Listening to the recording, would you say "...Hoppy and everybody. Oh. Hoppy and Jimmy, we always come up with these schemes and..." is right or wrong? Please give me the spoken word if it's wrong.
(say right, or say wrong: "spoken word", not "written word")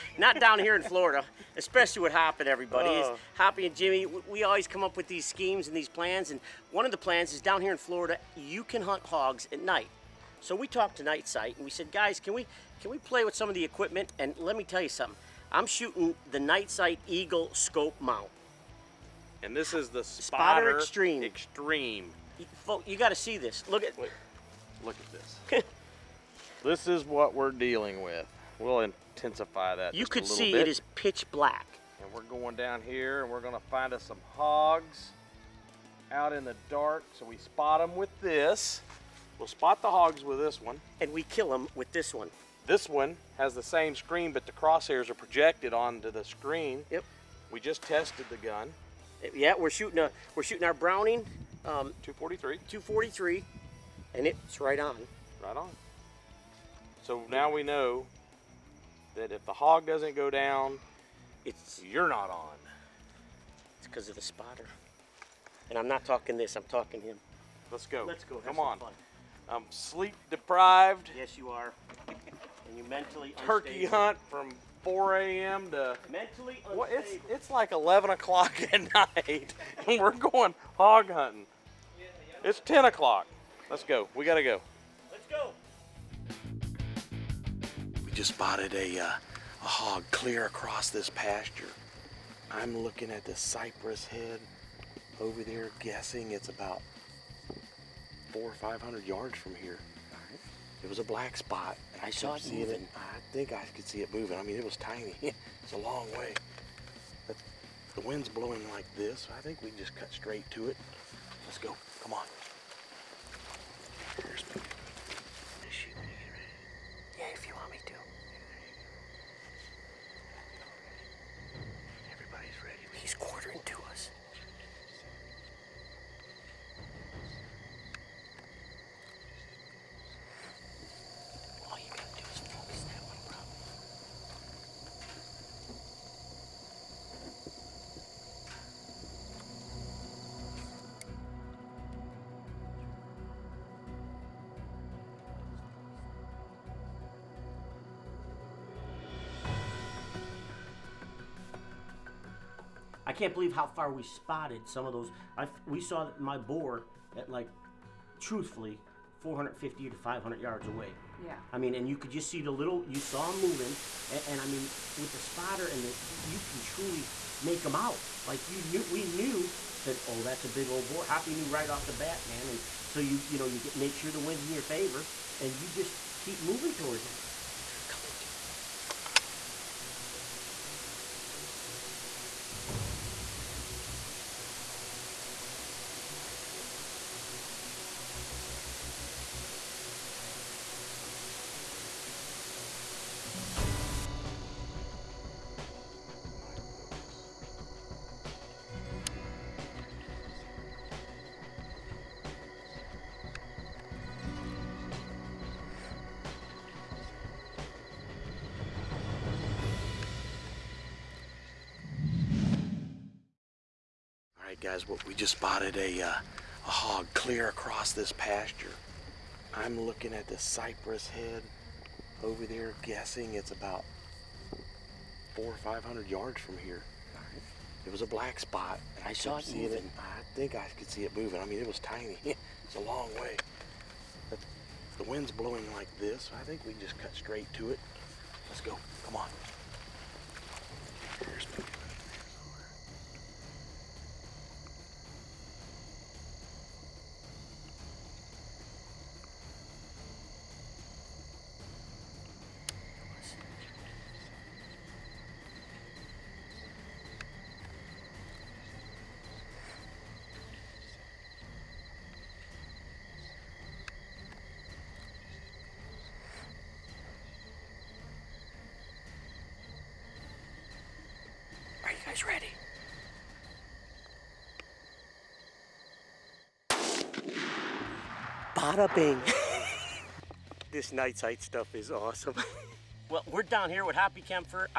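right.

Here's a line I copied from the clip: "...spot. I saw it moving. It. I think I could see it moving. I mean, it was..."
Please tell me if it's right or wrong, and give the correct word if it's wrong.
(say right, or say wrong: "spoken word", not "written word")
right.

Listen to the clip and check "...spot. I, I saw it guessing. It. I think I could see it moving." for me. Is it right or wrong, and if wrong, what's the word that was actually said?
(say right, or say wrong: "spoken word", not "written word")
wrong: "moving", not "guessing".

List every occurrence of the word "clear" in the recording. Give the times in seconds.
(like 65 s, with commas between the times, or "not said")
90 s, 217 s.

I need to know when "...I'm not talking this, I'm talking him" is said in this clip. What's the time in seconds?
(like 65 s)
65 s.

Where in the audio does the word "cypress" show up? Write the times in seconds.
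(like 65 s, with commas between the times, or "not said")
93 s, 220 s.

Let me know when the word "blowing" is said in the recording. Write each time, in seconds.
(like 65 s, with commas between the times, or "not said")
108 s, 235 s.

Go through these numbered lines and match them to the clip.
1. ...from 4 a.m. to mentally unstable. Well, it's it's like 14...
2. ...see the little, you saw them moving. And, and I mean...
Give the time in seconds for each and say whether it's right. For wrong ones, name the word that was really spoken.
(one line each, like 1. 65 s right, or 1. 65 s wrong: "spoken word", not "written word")
1. 74 s wrong: "11", not "14"
2. 162 s right.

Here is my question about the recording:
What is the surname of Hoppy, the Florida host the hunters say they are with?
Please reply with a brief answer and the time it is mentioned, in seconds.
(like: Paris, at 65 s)
Kempfer, at 284 s.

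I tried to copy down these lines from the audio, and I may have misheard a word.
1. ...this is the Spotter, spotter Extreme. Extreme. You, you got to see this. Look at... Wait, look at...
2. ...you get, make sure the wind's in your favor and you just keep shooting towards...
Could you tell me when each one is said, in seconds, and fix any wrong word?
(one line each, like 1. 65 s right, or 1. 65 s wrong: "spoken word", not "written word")
1. 19 s right
2. 173 s wrong: "moving", not "shooting".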